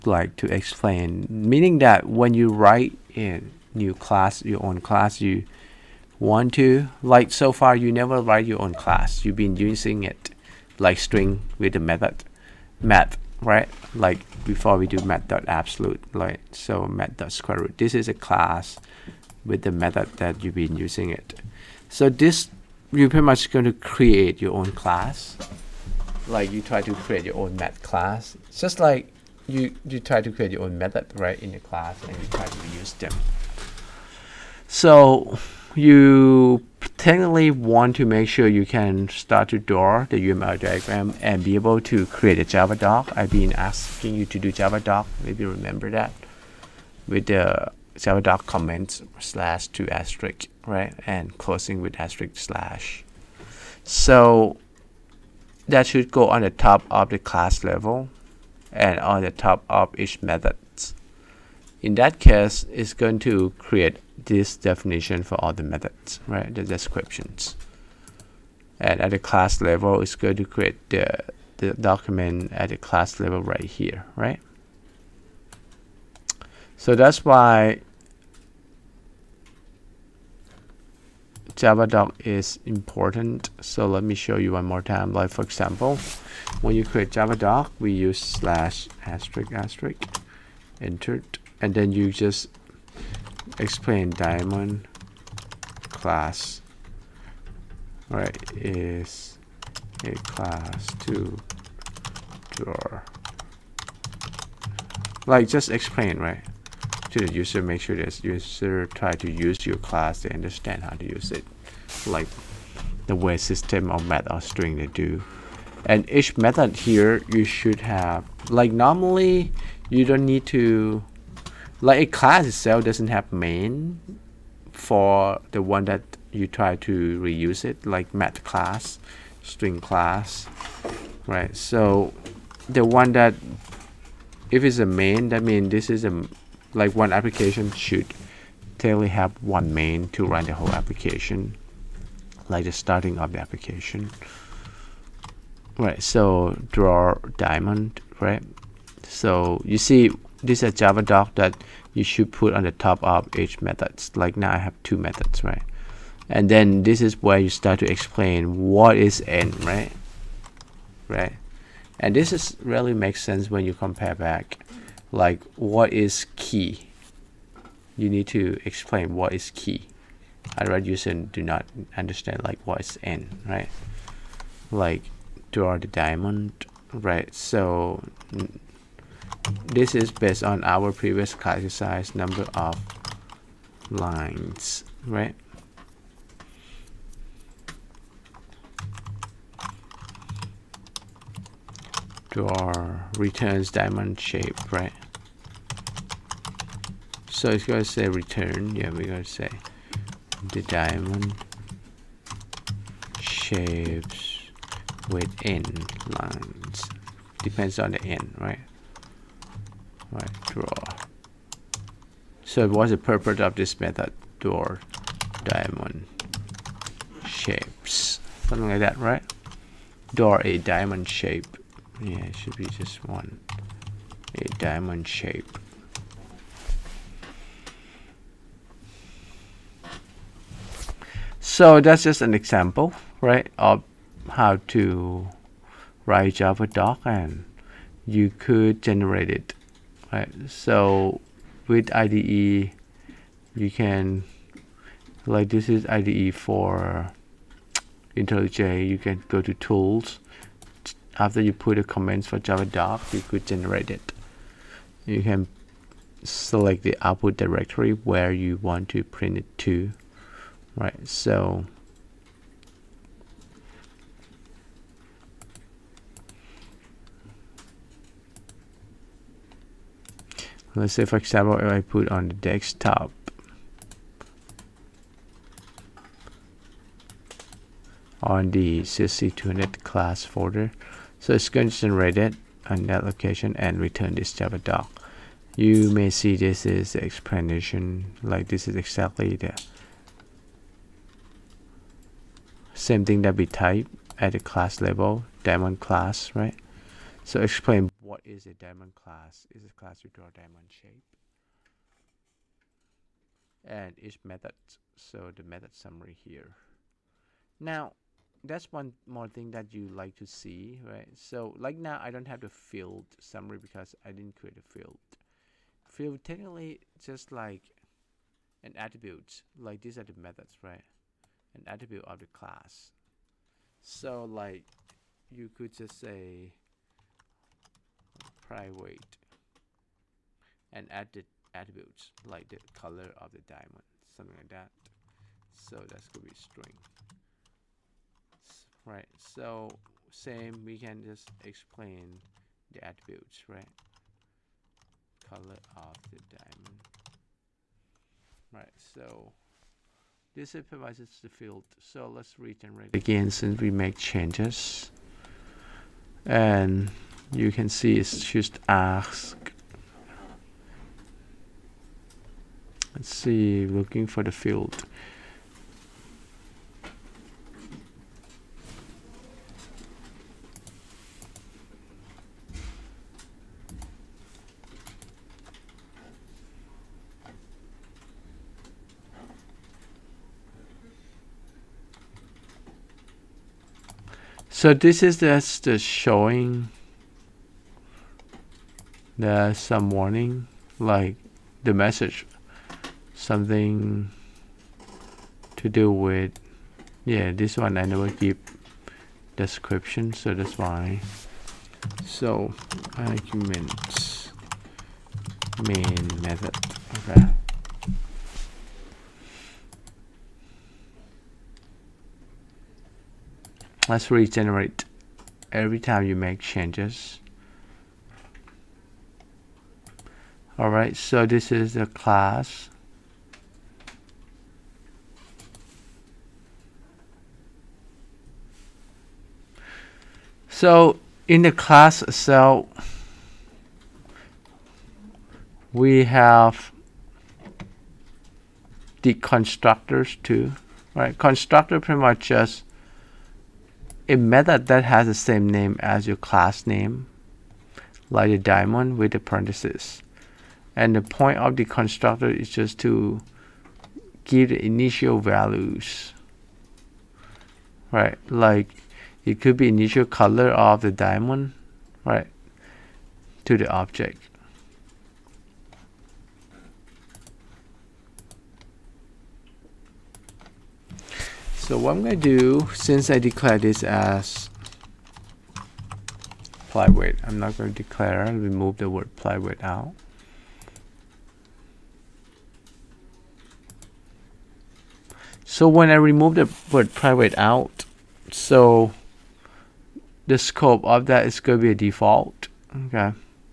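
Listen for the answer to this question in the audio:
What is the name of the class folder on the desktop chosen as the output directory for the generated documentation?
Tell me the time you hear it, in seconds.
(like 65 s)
278 s.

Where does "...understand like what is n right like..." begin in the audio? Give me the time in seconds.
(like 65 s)
171 s.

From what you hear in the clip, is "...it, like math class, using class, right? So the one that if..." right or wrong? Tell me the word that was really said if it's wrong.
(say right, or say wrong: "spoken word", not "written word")
wrong: "string", not "using".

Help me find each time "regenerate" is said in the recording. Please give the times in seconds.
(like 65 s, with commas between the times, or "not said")
352 s, 414 s.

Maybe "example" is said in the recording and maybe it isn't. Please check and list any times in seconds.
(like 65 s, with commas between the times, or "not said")
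85 s, 232 s, 271 s.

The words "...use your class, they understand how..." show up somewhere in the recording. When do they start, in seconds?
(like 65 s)
109 s.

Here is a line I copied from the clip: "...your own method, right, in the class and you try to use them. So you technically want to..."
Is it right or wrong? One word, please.
right.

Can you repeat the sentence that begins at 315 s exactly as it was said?
Field technically just like an attribute, like these are the methods, right?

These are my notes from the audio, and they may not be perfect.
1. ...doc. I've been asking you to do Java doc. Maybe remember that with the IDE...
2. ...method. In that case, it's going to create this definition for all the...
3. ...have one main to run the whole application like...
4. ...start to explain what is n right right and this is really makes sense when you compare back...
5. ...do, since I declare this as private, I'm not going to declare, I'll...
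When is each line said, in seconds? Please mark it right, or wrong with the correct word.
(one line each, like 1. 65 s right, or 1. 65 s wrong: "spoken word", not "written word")
1. 42 s wrong: "Java", not "IDE"
2. 60 s right
3. 139 s right
4. 157 s right
5. 472 s right.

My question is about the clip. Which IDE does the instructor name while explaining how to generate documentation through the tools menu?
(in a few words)
IntelliJ.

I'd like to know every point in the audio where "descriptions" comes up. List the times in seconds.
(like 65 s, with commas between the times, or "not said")
66 s, 399 s.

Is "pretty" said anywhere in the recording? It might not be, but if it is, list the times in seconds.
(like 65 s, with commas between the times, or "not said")
23 s, 441 s.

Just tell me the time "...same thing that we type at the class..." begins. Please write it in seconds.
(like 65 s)
292 s.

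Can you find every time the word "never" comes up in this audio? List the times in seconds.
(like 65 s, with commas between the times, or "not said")
7 s, 397 s.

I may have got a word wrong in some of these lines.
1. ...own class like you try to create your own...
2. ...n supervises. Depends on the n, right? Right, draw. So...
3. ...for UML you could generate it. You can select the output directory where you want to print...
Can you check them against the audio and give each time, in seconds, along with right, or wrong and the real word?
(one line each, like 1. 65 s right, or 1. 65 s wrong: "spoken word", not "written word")
1. 24 s right
2. 205 s wrong: "lines", not "supervises"
3. 252 s wrong: "Java", not "UML".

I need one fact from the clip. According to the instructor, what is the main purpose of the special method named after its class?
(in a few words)
initial values.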